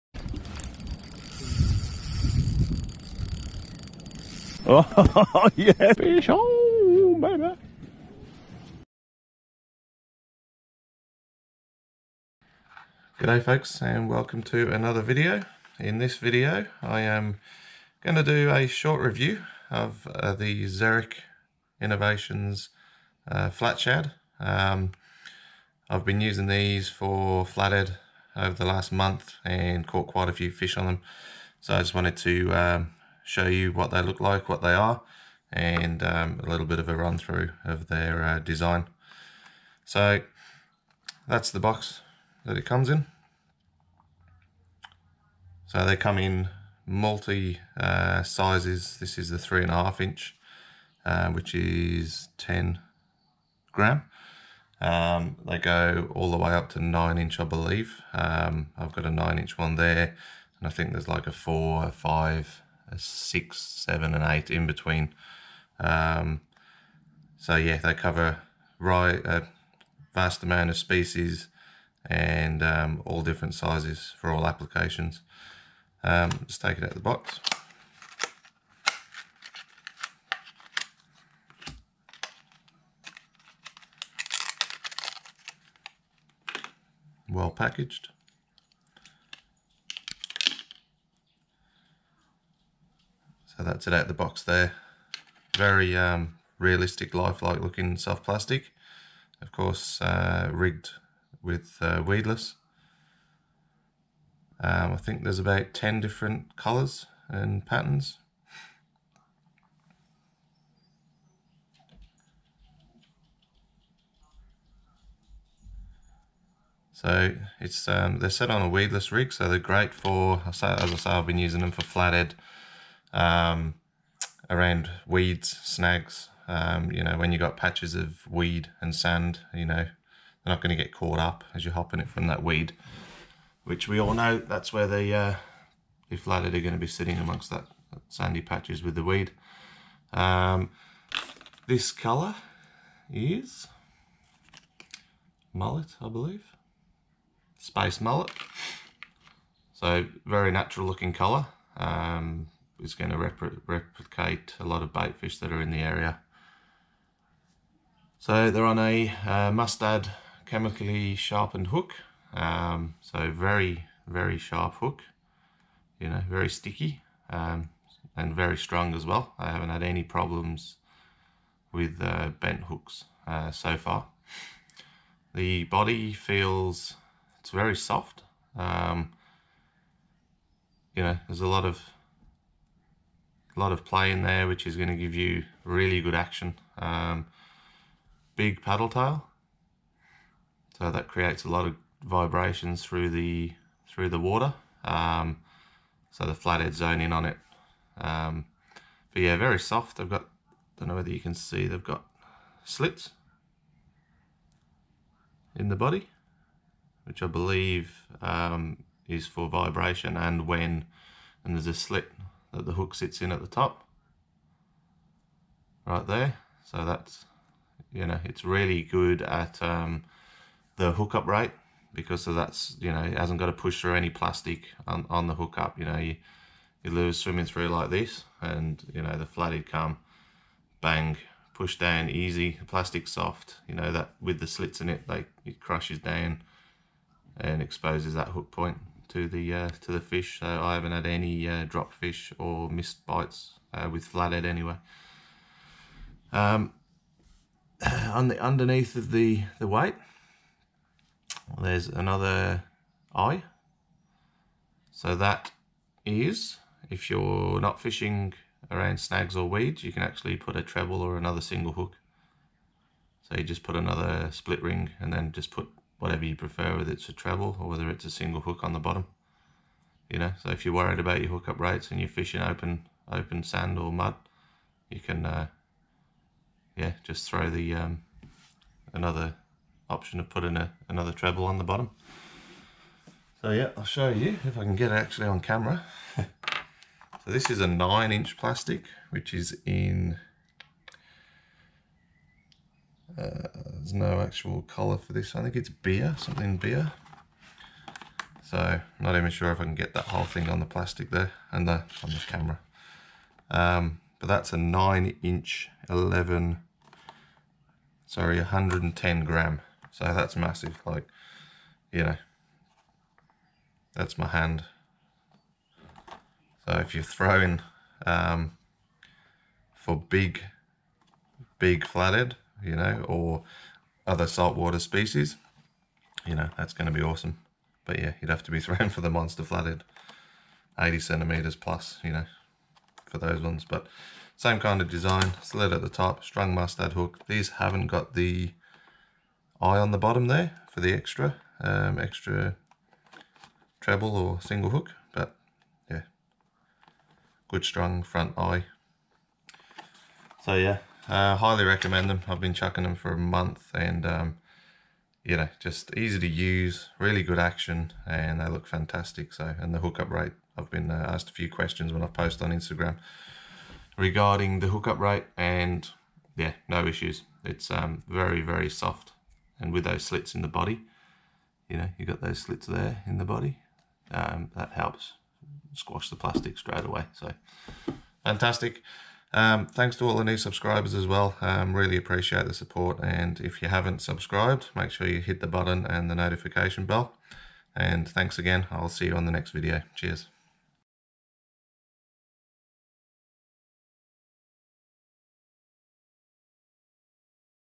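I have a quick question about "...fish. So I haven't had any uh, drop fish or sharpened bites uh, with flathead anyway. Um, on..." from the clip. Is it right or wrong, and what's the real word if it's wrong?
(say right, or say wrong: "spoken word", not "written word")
wrong: "missed", not "sharpened".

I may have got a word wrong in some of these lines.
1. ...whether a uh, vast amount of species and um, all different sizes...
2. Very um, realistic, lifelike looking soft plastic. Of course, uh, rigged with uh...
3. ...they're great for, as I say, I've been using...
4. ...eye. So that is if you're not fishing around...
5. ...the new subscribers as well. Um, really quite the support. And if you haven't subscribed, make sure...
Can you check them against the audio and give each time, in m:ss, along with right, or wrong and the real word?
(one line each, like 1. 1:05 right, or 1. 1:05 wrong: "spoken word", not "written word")
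1. 1:07 wrong: "cover", not "whether"
2. 1:35 right
3. 1:59 right
4. 4:13 right
5. 6:20 wrong: "appreciate", not "quite".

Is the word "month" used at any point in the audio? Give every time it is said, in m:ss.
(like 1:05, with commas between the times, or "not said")
0:28, 5:53.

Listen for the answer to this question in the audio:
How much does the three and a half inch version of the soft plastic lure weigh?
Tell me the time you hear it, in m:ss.
0:52.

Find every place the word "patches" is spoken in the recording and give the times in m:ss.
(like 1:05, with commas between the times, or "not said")
2:07, 2:18.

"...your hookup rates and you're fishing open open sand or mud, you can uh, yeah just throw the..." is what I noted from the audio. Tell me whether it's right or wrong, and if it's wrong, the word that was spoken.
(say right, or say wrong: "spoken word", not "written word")
right.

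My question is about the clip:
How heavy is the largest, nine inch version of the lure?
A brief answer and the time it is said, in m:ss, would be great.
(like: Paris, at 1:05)
110 gram, at 5:08.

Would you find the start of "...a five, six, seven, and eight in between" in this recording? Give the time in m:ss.
1:01.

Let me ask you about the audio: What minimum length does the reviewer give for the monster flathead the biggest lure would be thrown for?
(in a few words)
80 centimeters.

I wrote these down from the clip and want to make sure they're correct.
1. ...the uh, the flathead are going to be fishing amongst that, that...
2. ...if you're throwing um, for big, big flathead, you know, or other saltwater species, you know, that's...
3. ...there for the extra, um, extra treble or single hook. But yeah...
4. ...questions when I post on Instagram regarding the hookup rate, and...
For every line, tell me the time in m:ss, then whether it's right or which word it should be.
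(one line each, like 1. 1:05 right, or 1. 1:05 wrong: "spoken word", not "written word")
1. 2:14 wrong: "sitting", not "fishing"
2. 5:16 right
3. 5:40 right
4. 6:01 right.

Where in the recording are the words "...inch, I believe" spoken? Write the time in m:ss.
0:57.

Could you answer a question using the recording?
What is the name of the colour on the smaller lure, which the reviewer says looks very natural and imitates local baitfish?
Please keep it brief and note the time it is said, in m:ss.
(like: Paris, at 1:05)
space mullet, at 2:27.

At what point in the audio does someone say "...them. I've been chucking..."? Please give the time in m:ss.
5:52.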